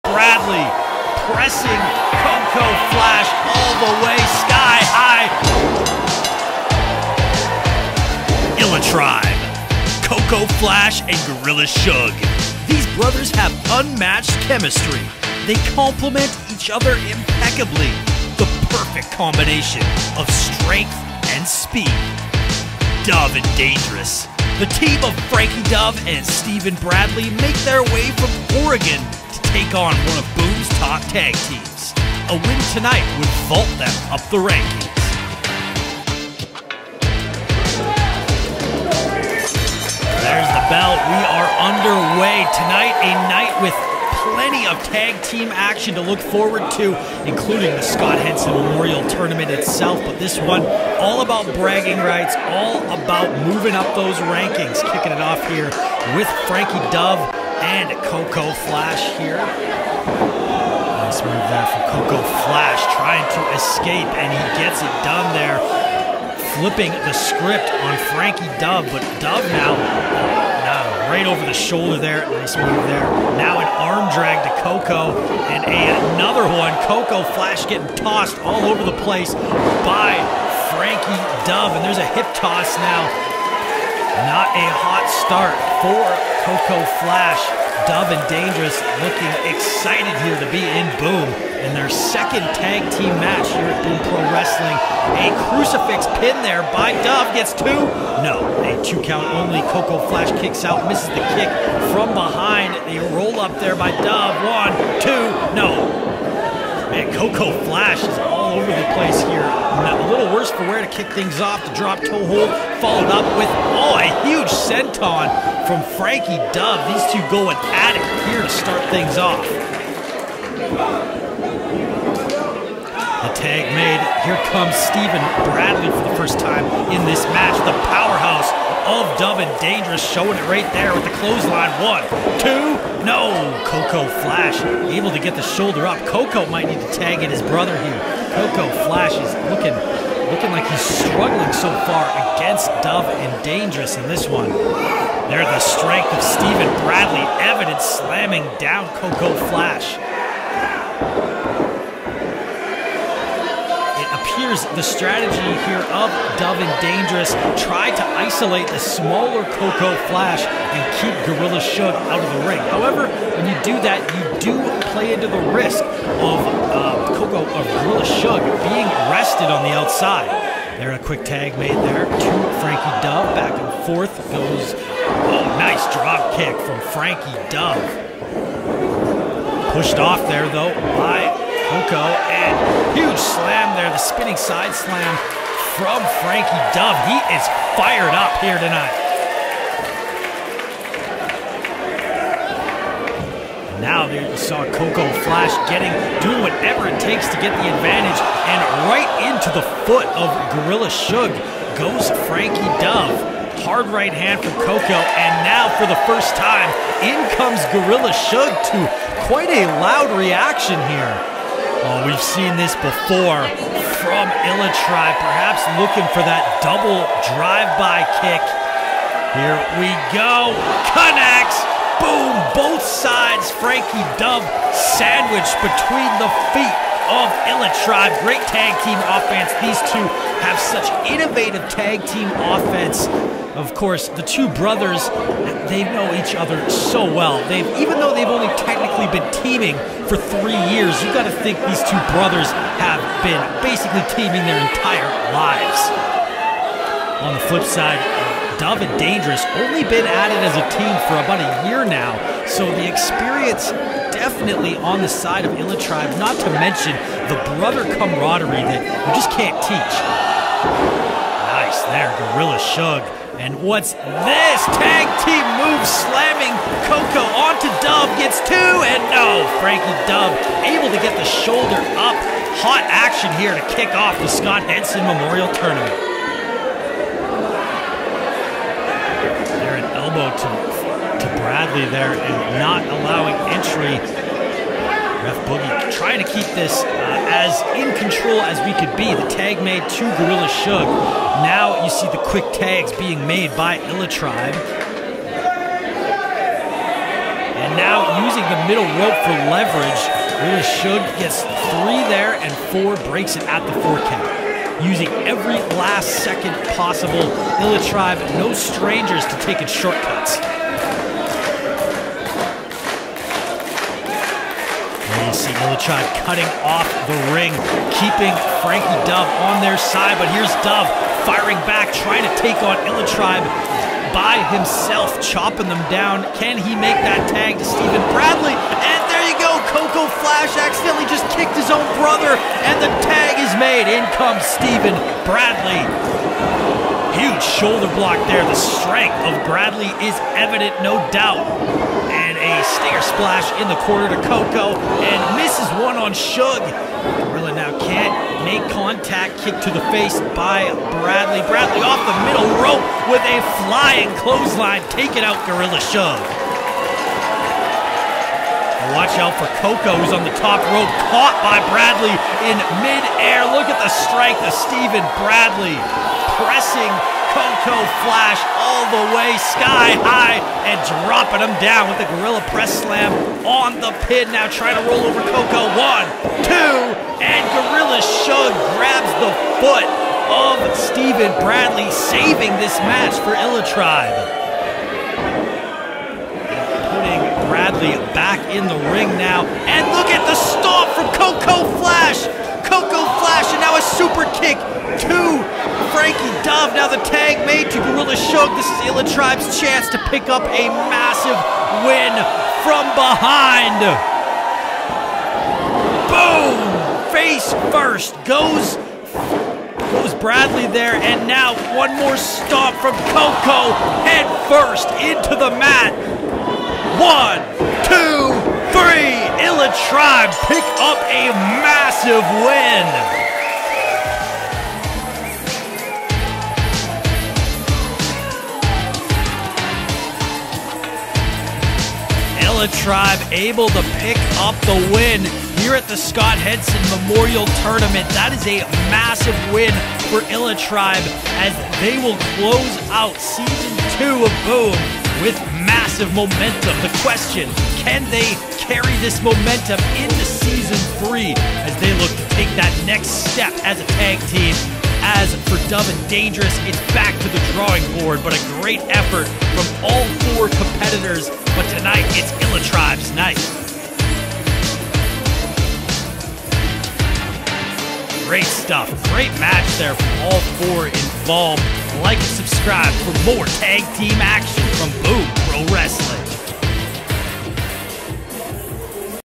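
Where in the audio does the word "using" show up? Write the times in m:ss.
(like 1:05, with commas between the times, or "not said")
4:58, 5:04.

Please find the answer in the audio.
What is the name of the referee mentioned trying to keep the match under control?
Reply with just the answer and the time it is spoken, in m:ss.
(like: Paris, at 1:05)
Boogie, at 4:45.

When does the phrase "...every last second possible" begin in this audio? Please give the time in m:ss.
5:05.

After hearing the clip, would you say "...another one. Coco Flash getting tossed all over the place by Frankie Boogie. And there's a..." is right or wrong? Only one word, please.
wrong.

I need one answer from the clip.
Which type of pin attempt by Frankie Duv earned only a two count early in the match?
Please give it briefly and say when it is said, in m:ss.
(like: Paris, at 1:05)
crucifix pin, at 1:35.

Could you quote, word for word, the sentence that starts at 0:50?
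But this one, all about bragging rights, all about moving up those rankings.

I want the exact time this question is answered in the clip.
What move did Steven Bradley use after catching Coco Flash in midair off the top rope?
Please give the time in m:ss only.
6:12.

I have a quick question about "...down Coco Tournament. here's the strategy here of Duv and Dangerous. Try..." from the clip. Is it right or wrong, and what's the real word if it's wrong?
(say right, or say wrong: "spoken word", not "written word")
wrong: "Flash", not "Tournament".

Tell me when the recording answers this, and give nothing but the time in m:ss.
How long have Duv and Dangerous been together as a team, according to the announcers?
4:11.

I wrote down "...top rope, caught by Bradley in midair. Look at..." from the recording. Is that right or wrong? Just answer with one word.
right.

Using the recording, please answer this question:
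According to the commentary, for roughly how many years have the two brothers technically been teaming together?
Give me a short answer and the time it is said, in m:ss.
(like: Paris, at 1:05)
3, at 4:00.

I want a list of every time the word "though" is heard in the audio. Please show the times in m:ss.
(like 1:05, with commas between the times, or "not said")
3:00, 3:57.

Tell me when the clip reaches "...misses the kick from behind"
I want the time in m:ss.
1:40.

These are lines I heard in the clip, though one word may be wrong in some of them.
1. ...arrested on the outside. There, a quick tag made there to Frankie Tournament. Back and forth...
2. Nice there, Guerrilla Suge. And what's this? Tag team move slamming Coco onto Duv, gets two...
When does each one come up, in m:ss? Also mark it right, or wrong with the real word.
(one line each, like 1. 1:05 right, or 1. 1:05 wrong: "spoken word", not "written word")
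1. 2:49 wrong: "Duv", not "Tournament"
2. 4:21 right.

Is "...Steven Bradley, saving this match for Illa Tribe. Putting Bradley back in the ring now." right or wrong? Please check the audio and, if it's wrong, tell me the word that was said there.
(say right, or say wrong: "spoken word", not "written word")
right.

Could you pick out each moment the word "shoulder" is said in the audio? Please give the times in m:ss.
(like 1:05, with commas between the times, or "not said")
1:11, 2:15, 4:31, 5:37.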